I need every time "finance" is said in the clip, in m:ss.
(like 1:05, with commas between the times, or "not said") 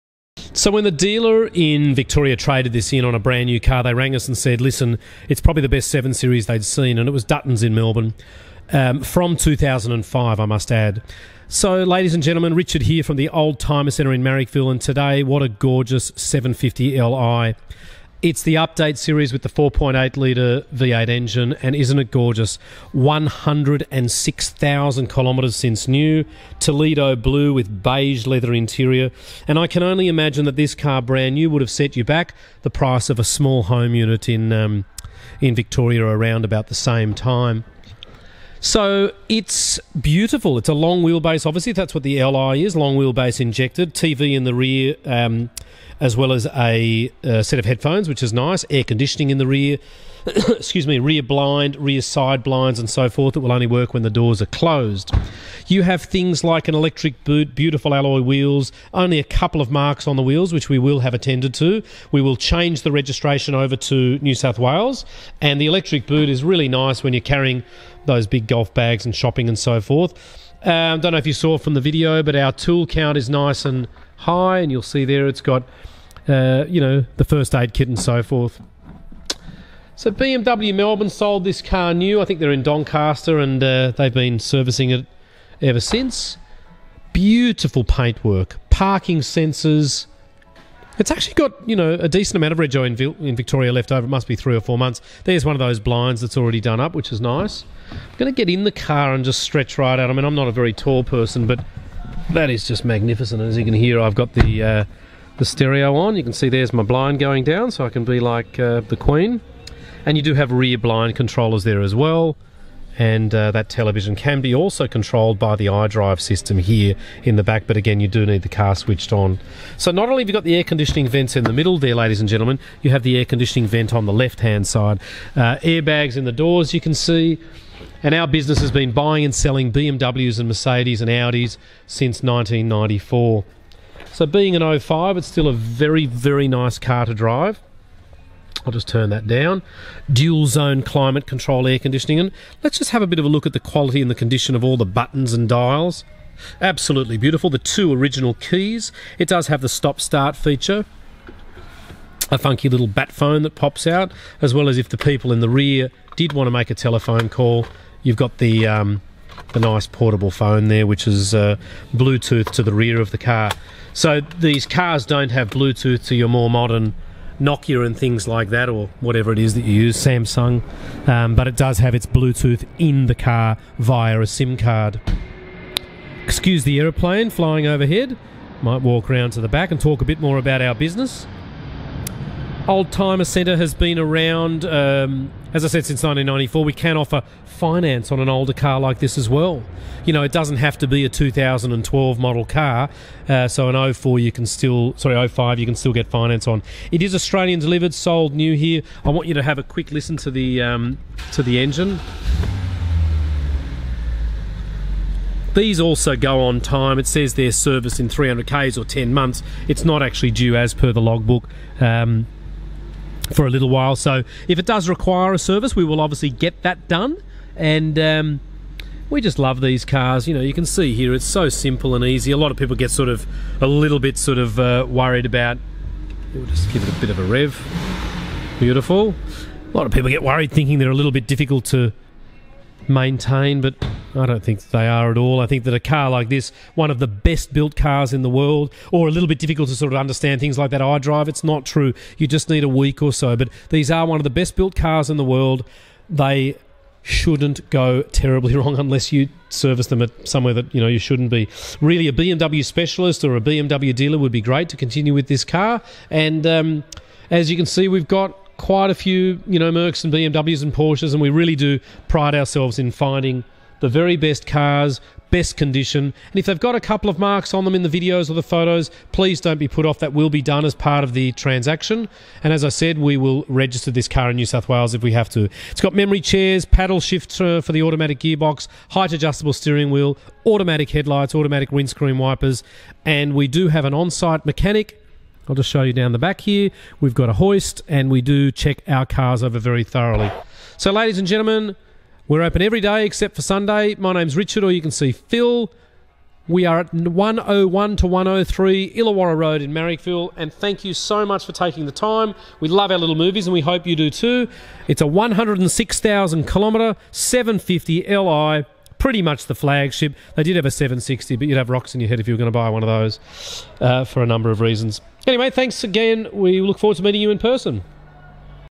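3:07, 3:16.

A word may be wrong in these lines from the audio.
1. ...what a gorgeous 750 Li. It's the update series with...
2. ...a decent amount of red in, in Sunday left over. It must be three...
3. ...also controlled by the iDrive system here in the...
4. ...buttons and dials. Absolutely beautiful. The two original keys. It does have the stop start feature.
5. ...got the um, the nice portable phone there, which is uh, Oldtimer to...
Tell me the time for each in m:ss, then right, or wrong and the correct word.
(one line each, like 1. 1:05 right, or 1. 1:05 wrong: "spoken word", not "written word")
1. 0:15 right
2. 1:31 wrong: "Victoria", not "Sunday"
3. 1:54 right
4. 2:24 right
5. 2:38 wrong: "Bluetooth", not "Oldtimer".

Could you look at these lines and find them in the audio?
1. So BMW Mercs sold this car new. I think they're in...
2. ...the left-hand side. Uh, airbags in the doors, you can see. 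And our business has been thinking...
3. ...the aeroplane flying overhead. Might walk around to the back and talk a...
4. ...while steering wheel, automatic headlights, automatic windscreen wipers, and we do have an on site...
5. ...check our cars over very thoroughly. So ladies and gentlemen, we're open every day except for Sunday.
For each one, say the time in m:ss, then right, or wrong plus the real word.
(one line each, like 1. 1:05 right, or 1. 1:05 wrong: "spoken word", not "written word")
1. 1:19 wrong: "Melbourne", not "Mercs"
2. 2:04 wrong: "buying", not "thinking"
3. 2:56 right
4. 4:39 wrong: "adjustable", not "while"
5. 4:48 right.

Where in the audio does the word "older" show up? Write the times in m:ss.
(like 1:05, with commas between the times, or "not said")
3:08.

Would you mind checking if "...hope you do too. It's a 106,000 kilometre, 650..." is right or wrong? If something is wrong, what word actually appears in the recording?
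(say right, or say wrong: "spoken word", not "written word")
wrong: "750", not "650".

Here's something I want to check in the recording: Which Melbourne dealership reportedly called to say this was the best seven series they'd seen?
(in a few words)
Dutton's.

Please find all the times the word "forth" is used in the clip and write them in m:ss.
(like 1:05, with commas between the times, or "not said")
0:53, 1:09, 1:18.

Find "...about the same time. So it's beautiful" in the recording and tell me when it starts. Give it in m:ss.
0:36.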